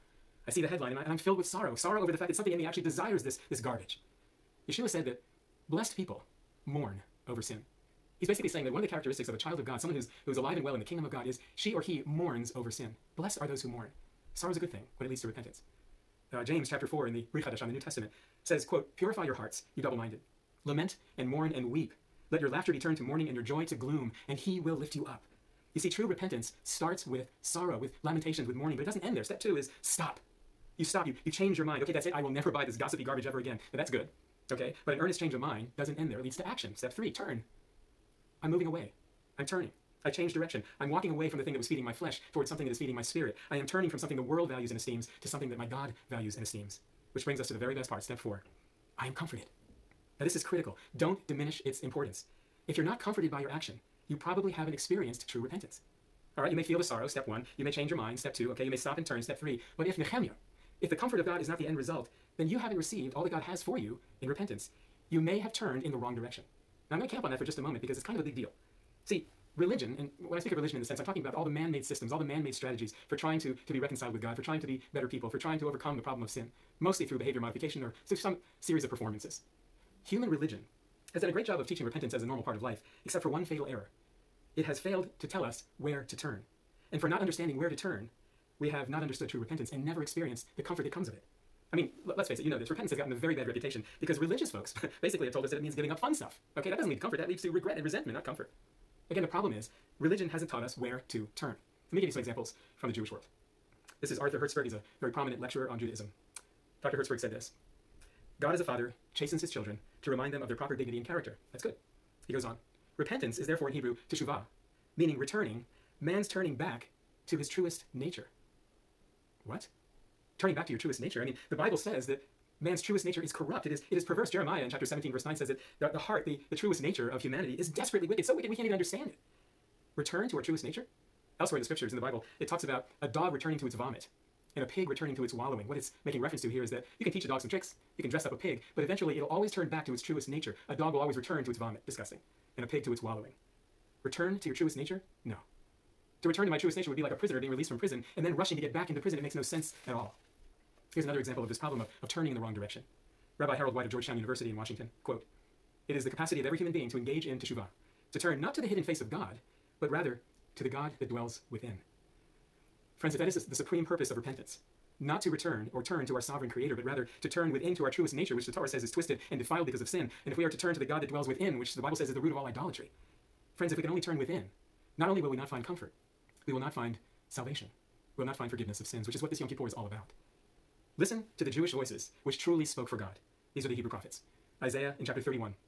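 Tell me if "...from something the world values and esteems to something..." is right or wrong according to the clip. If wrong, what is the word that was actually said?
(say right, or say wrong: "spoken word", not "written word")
right.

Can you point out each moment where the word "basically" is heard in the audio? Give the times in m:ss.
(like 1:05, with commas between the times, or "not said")
0:08, 1:35.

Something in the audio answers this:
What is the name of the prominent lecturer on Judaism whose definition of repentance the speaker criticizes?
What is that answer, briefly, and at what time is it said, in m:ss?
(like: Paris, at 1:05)
Arthur Hertzberg, at 1:44.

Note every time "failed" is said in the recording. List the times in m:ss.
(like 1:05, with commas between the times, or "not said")
1:24.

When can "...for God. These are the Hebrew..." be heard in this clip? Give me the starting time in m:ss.
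3:02.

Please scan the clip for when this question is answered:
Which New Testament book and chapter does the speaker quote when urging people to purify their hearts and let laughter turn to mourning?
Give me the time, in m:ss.
0:16.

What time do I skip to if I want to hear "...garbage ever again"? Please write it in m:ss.
0:33.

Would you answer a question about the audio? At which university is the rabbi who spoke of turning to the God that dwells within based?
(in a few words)
Georgetown University.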